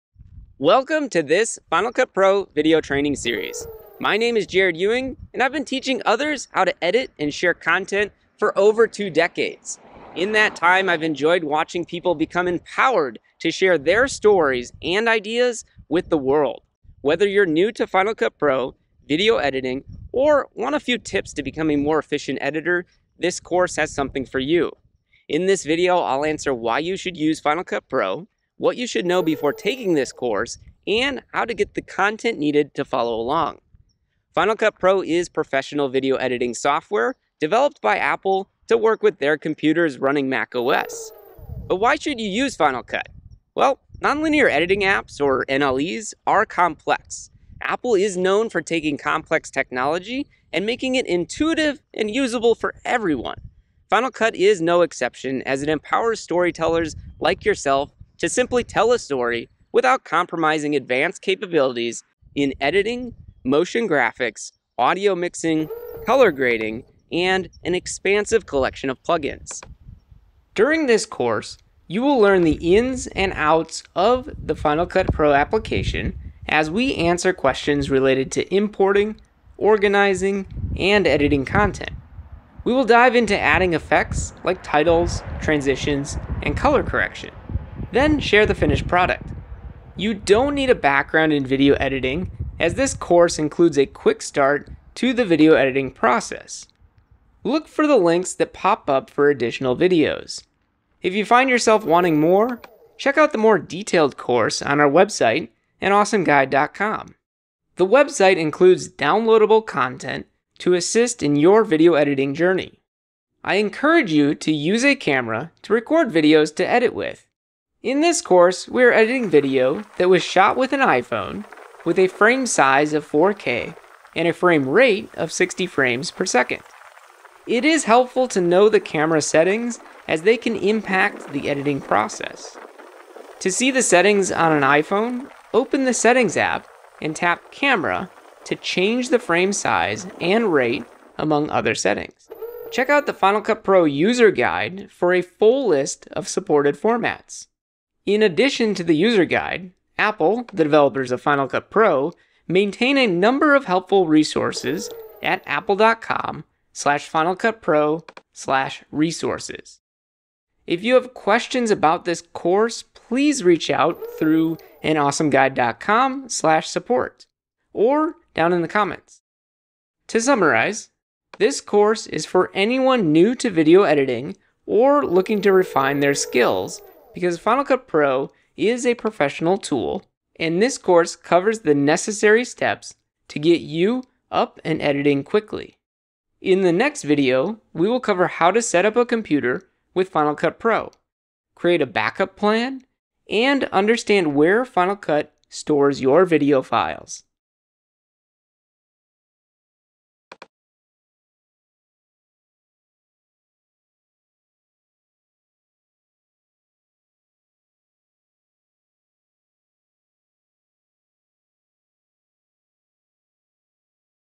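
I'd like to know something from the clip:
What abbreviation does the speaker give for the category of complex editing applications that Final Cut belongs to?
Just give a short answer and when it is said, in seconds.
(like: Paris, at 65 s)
NLEs, at 45 s.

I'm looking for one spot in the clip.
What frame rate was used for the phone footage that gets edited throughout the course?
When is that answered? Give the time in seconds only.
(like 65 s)
125 s.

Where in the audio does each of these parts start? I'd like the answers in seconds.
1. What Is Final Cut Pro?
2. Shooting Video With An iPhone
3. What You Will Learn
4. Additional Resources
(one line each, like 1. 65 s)
1. 33 s
2. 112 s
3. 69 s
4. 141 s.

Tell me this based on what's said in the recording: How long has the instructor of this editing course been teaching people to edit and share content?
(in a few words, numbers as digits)
Over two decades.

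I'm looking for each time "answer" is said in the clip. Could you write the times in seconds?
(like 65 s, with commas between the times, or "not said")
26 s, 76 s.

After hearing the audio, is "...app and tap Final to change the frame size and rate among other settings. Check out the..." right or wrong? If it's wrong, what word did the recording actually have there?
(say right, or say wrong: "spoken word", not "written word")
wrong: "Camera", not "Final".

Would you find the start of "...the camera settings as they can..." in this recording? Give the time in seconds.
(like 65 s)
128 s.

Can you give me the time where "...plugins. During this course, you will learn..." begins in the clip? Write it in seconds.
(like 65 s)
69 s.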